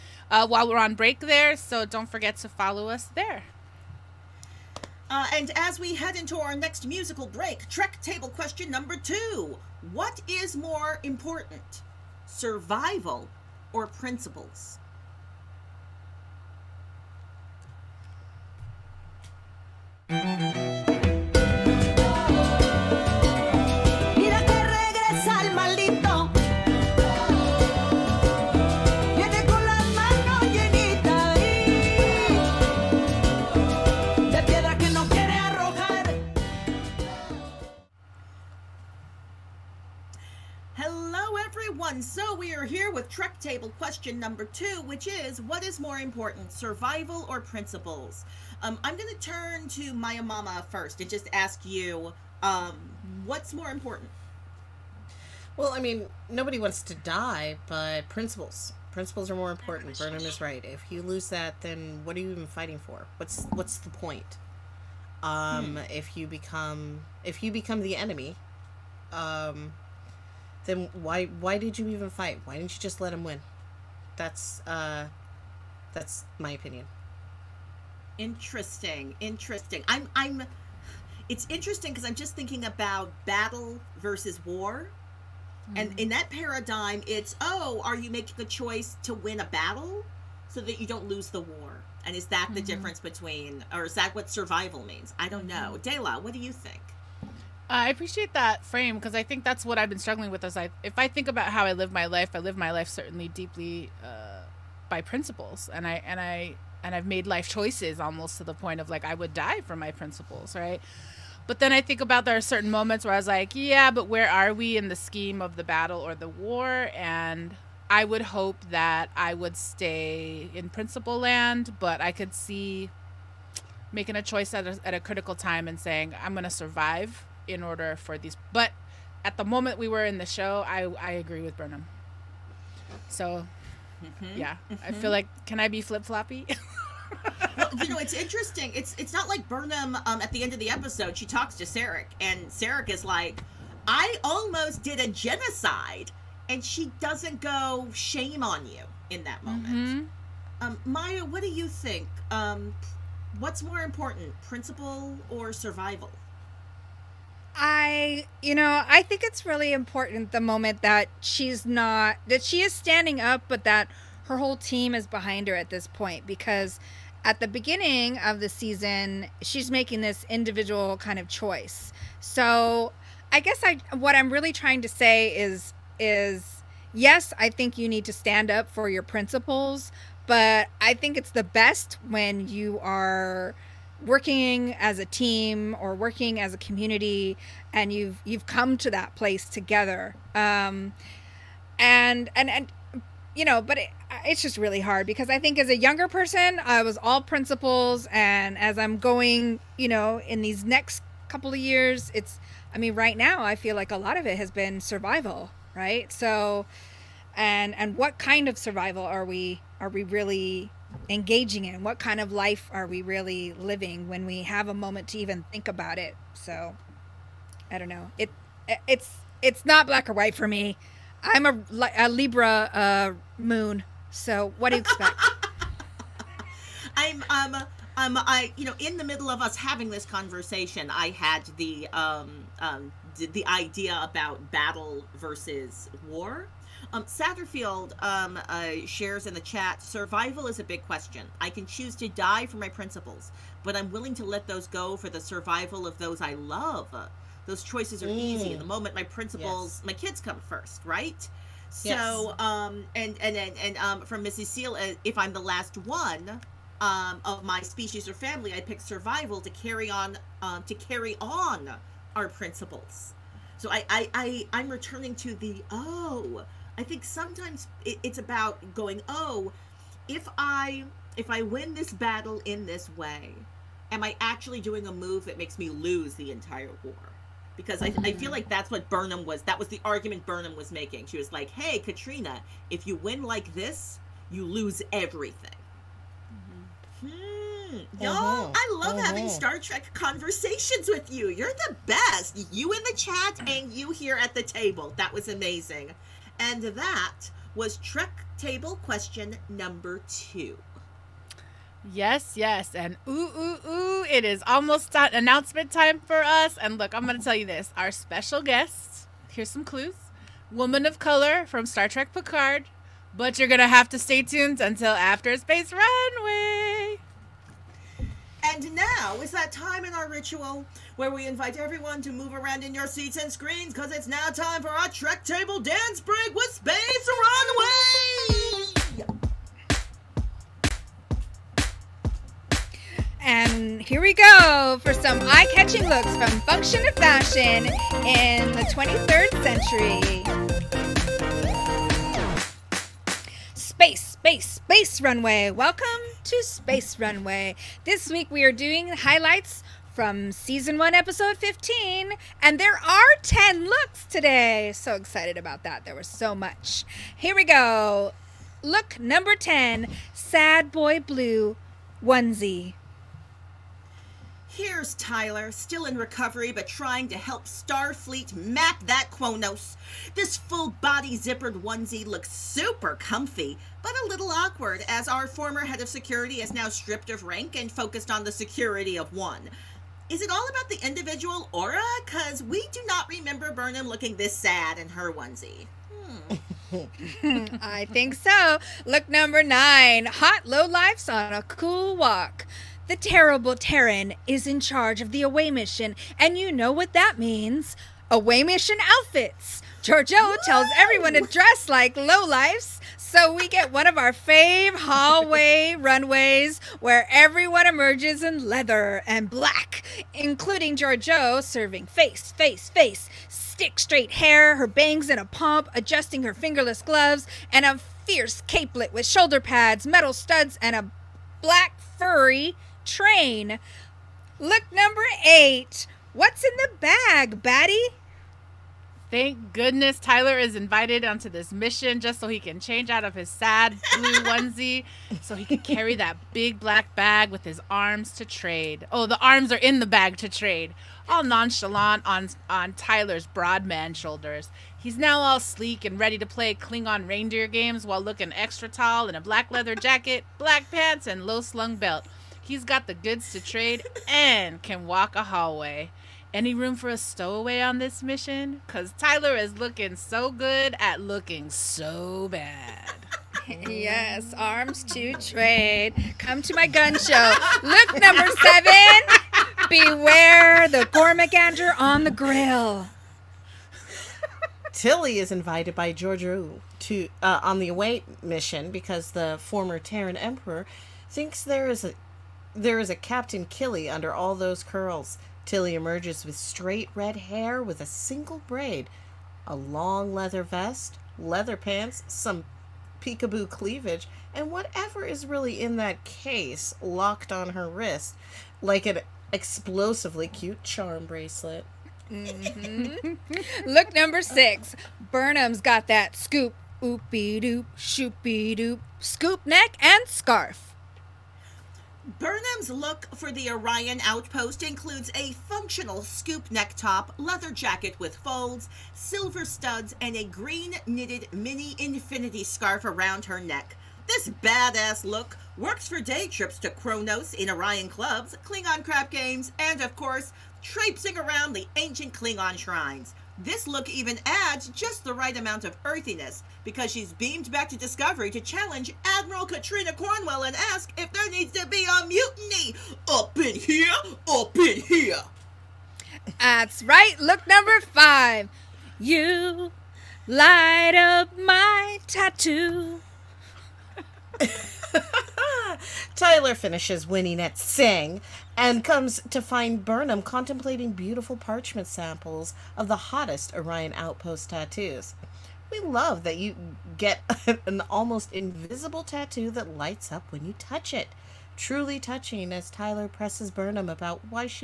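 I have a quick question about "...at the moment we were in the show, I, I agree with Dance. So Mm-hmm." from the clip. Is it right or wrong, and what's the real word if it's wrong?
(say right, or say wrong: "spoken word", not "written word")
wrong: "Burnham", not "Dance".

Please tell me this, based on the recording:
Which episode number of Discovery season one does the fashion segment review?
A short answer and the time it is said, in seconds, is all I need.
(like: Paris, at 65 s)
15, at 350 s.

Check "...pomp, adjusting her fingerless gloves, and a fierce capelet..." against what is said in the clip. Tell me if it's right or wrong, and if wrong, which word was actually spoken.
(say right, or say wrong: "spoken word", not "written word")
right.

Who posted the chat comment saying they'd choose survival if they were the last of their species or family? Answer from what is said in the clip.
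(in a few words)
Mrs. Seal.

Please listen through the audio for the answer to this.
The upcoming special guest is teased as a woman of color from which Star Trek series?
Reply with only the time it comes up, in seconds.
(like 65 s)
311 s.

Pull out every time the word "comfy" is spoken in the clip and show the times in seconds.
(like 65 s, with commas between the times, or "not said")
372 s.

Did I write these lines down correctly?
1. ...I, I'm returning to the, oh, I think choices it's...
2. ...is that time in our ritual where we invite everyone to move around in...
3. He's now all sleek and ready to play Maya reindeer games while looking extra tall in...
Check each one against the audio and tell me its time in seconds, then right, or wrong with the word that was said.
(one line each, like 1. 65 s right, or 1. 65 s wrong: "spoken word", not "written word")
1. 264 s wrong: "sometimes", not "choices"
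2. 319 s right
3. 444 s wrong: "Klingon", not "Maya".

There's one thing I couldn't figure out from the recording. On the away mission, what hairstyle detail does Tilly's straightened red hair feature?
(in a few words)
a single braid.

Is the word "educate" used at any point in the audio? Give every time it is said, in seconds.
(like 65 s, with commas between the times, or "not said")
not said.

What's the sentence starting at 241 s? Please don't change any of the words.
I can choose to die for my principles, but I'm willing to let those go for the survival of those I love.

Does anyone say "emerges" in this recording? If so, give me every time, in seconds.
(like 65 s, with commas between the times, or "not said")
407 s, 485 s.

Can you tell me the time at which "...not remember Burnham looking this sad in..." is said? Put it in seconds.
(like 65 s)
382 s.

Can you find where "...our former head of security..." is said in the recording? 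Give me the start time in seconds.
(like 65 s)
375 s.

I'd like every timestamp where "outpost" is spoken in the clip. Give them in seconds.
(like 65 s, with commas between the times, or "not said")
514 s, 563 s.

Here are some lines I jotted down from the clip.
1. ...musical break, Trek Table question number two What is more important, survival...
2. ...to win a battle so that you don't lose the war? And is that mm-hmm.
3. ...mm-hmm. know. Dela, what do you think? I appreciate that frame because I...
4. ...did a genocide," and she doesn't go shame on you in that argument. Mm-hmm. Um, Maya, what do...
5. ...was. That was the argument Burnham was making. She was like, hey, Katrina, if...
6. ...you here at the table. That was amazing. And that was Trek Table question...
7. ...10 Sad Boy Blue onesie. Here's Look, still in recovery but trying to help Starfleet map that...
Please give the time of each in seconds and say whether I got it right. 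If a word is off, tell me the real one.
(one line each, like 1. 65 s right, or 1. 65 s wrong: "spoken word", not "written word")
1. 6 s right
2. 89 s right
3. 95 s right
4. 144 s wrong: "moment", not "argument"
5. 279 s right
6. 293 s right
7. 359 s wrong: "Tyler", not "Look".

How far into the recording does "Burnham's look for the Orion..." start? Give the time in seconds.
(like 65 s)
512 s.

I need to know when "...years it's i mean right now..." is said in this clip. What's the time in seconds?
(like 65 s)
201 s.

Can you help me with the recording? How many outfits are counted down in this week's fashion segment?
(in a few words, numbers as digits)
10.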